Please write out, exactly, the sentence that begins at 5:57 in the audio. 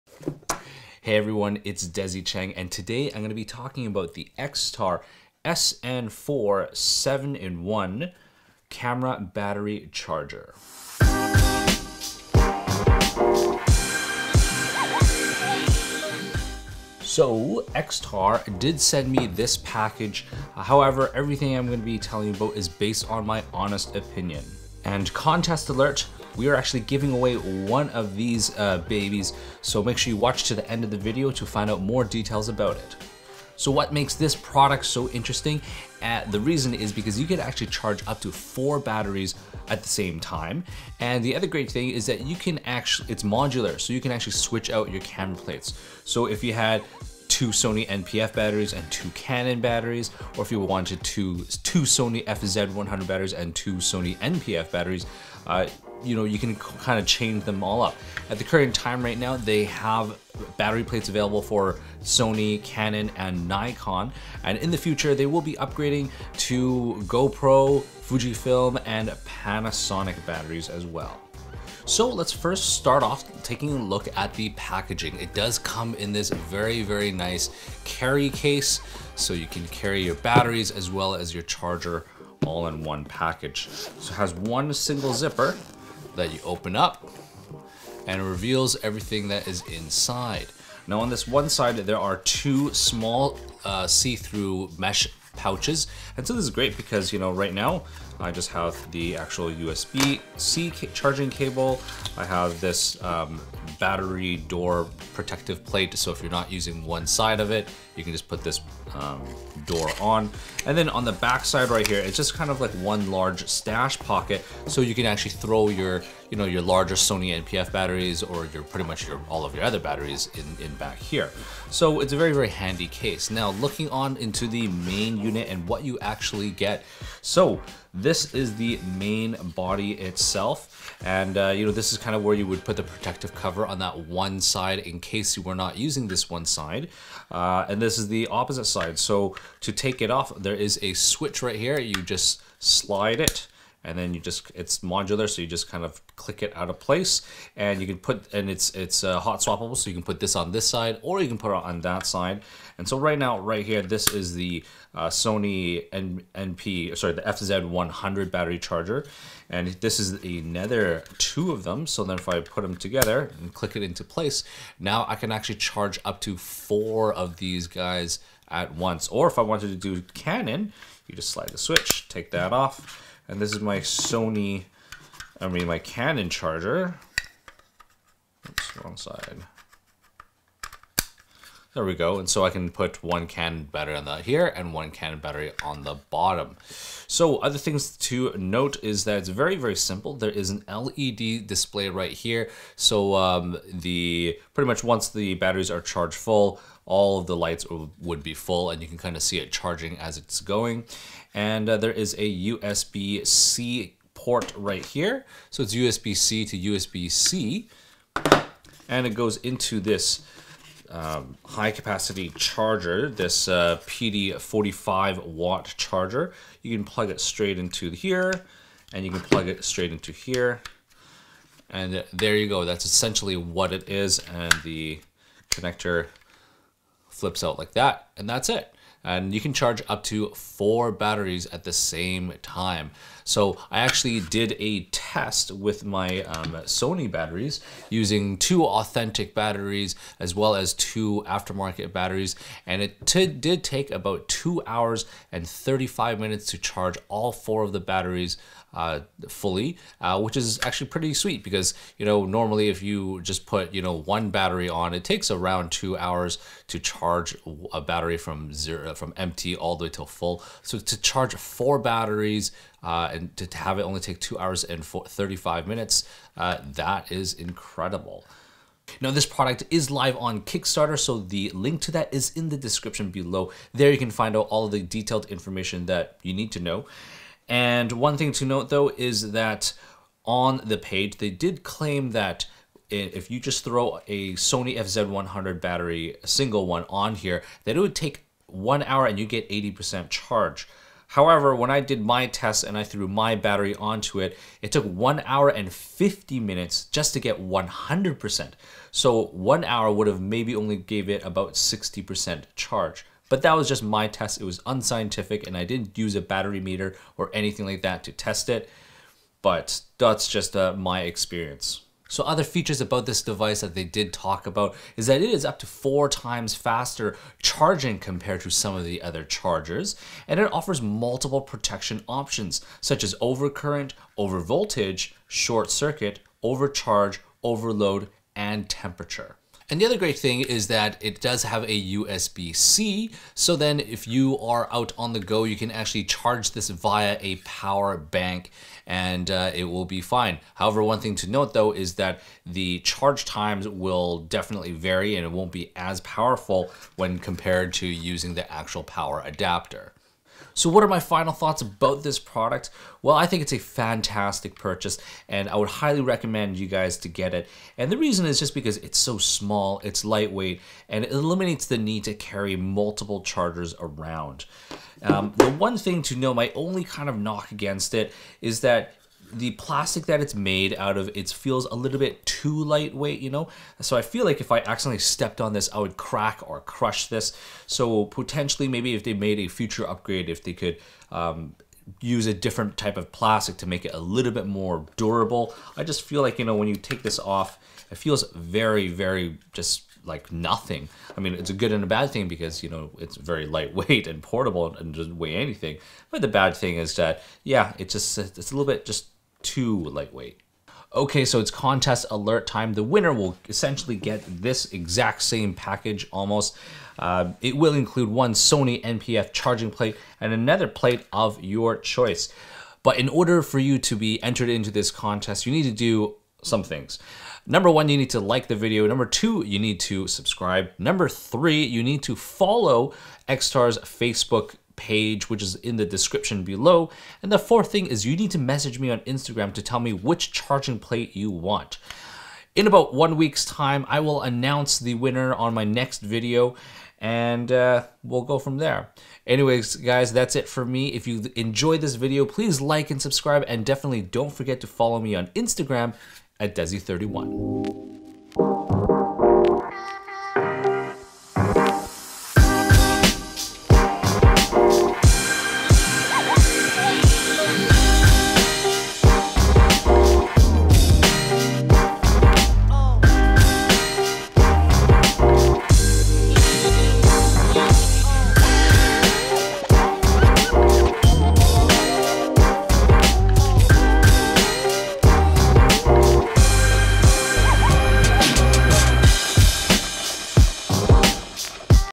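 And the reason is just because it's so small, it's lightweight, and it eliminates the need to carry multiple chargers around.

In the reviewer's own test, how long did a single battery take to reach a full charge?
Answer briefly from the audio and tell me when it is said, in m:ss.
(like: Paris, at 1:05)
1 hour 50 minutes, at 4:54.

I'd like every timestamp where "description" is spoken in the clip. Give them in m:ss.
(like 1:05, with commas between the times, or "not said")
4:32, 7:05.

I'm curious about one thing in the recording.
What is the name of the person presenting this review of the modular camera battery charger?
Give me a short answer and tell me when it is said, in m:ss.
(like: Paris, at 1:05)
Desy Cheng, at 0:01.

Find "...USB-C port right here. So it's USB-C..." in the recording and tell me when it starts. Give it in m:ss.
3:22.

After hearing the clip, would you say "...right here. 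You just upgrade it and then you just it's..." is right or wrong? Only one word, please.
wrong.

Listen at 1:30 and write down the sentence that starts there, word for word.
Now on this one side, there are two small uh, see-through mesh pouches.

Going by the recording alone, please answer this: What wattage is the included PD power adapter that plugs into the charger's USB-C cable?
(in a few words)
45 watts.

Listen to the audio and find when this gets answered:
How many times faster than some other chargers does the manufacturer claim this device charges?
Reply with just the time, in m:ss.
5:15.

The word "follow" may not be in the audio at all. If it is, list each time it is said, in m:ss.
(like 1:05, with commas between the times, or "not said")
7:02, 7:24.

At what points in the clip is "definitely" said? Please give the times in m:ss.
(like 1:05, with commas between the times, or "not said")
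5:44, 7:23.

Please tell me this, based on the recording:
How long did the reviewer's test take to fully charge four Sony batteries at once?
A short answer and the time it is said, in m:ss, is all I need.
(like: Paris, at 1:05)
2 hours 35 minutes, at 4:04.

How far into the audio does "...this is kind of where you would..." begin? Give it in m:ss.
2:11.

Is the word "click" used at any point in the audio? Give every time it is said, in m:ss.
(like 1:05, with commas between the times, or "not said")
2:26, 2:43.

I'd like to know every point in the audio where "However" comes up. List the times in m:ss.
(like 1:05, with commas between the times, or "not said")
0:20, 4:51, 5:40.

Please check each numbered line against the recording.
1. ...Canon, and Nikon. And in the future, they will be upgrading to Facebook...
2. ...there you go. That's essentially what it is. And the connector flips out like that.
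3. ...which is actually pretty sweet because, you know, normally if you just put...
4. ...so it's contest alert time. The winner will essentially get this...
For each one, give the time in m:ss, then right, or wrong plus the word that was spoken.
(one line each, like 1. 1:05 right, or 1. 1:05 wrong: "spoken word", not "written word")
1. 1:02 wrong: "GoPro", not "Facebook"
2. 3:42 right
3. 4:10 right
4. 6:41 right.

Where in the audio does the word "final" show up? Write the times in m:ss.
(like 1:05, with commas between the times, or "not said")
5:50.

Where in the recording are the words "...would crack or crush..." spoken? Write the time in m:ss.
6:15.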